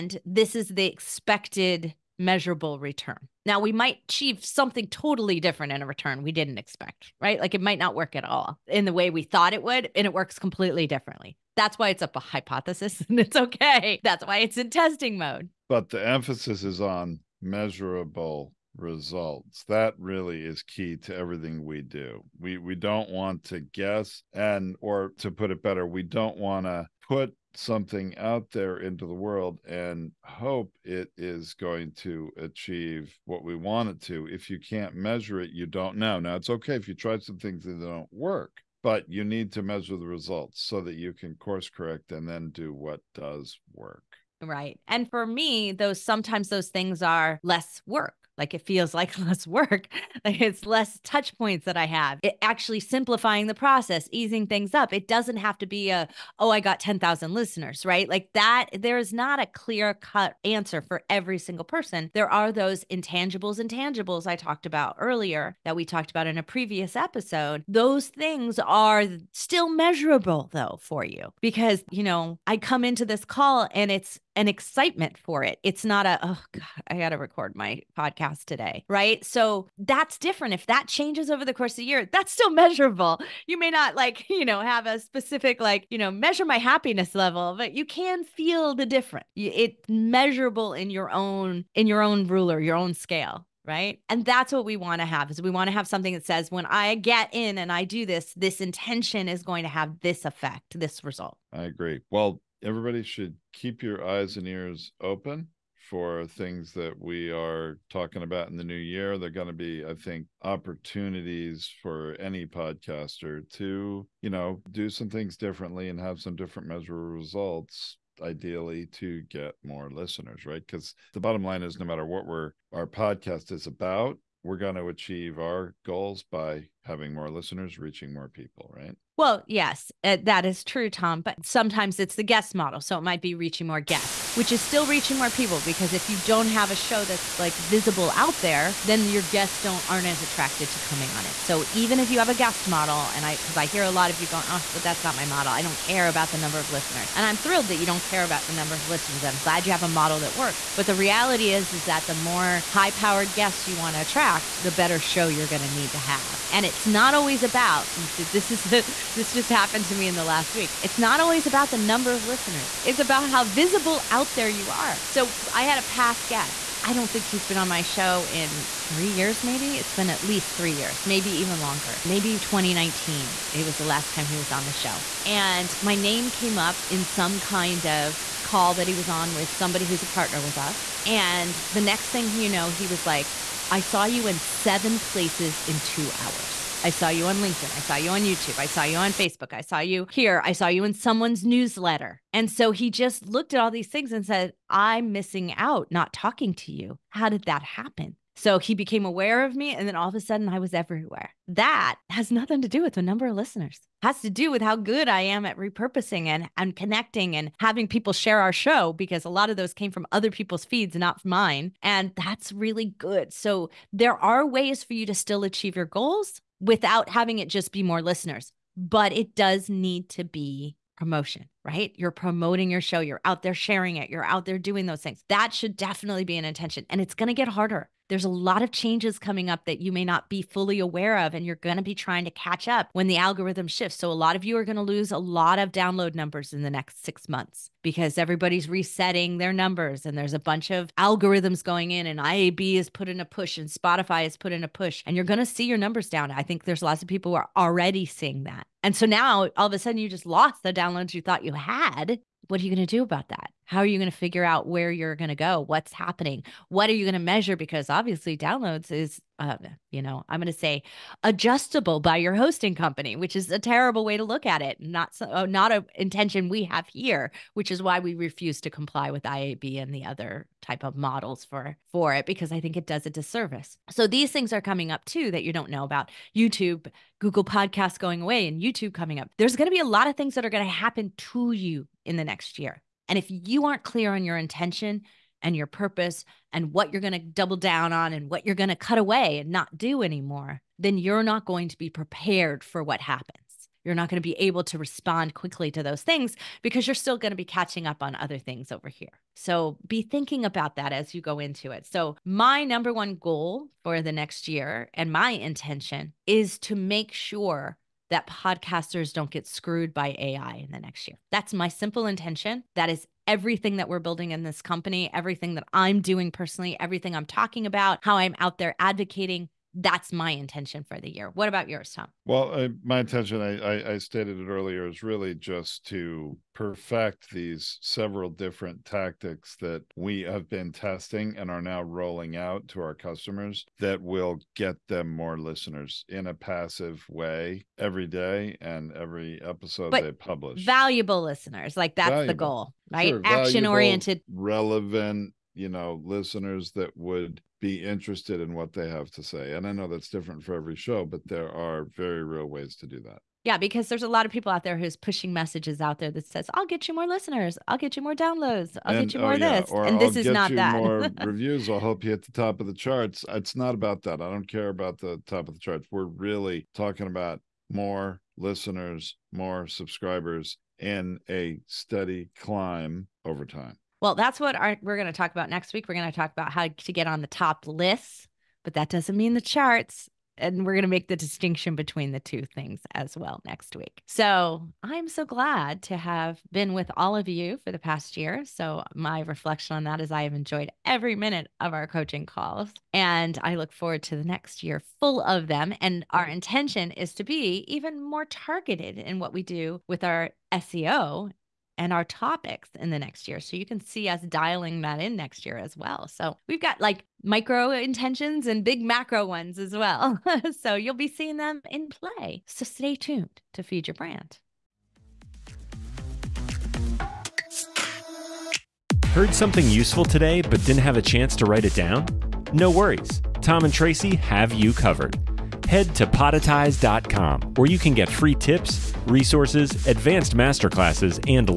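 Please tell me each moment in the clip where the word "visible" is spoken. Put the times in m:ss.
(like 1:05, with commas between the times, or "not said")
2:17, 2:43.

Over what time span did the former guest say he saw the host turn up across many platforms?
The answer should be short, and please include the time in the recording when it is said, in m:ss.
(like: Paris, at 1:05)
2 hours, at 3:05.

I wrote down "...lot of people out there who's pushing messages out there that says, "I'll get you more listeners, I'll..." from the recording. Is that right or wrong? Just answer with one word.
right.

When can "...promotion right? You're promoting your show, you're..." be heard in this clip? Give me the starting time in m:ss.
3:40.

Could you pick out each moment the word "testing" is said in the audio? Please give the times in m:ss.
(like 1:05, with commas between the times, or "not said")
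0:14, 5:30.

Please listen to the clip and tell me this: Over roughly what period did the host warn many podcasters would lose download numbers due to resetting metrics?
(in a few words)
6 months.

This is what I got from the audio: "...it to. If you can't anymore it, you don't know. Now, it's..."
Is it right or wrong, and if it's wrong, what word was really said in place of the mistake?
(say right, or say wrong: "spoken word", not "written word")
wrong: "measure", not "anymore".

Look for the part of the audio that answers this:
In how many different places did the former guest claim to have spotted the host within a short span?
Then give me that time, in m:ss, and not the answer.
3:04.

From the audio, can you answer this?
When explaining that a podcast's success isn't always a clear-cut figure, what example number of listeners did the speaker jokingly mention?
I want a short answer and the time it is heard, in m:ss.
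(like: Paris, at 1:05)
10,000, at 0:56.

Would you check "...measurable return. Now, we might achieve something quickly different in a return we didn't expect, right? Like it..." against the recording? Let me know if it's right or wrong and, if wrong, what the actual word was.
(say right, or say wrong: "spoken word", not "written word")
wrong: "totally", not "quickly".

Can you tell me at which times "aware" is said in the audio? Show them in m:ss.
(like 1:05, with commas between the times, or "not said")
3:19, 3:50.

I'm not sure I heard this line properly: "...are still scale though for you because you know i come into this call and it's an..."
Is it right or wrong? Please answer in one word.
wrong.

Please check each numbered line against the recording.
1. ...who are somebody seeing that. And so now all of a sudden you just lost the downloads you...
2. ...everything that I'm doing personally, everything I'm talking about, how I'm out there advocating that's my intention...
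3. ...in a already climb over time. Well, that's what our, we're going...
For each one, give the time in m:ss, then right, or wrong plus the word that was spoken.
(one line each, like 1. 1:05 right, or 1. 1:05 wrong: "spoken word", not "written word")
1. 4:07 wrong: "already", not "somebody"
2. 5:15 right
3. 6:10 wrong: "steady", not "already".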